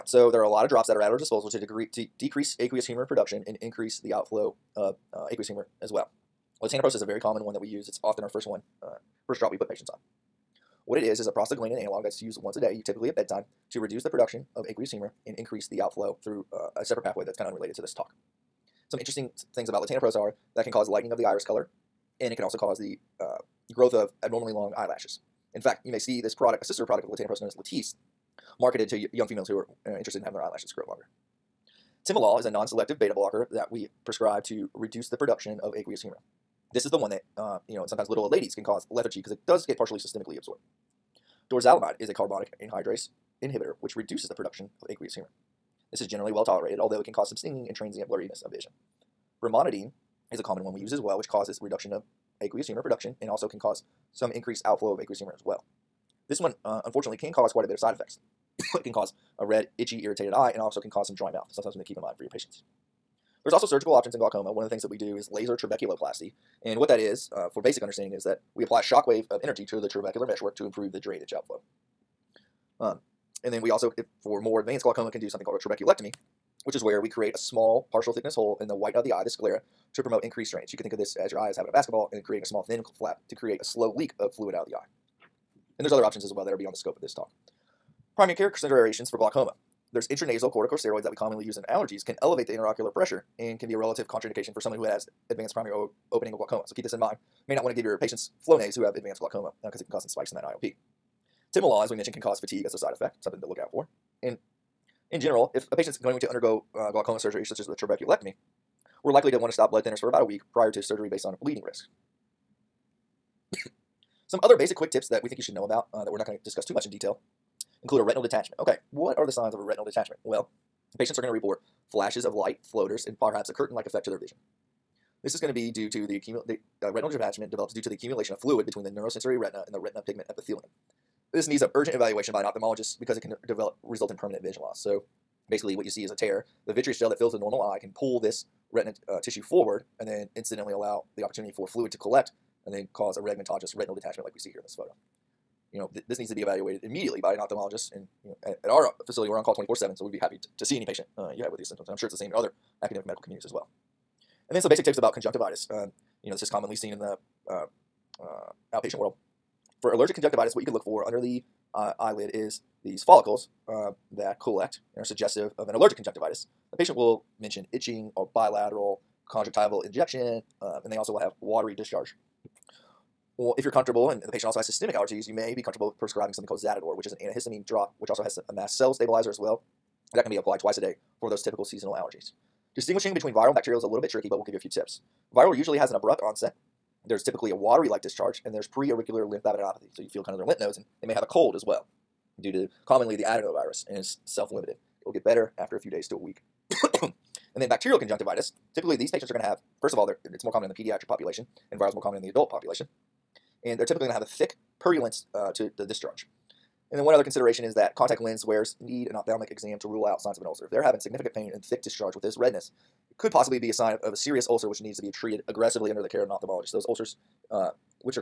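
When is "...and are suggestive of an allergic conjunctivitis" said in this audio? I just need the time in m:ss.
2:44.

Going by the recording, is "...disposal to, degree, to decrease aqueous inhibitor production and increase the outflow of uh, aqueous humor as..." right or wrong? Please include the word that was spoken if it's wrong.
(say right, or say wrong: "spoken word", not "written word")
wrong: "humor", not "inhibitor".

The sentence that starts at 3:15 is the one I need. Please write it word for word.
It will get better after a few days to a week.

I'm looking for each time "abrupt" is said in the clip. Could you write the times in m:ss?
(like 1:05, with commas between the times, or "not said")
3:05.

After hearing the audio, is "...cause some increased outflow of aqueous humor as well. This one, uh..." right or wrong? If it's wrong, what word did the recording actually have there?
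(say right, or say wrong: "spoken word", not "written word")
right.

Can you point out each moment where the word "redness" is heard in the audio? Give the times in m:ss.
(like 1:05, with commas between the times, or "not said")
3:32.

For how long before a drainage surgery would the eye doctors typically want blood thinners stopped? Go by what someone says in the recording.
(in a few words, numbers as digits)
about a week.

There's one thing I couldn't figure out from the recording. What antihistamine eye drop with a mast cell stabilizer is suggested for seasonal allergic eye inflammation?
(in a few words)
Zaditor.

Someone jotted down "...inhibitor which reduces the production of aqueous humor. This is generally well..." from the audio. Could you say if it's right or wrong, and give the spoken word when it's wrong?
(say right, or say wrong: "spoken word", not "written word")
right.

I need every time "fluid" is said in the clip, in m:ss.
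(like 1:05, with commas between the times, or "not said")
1:24, 2:08, 2:21.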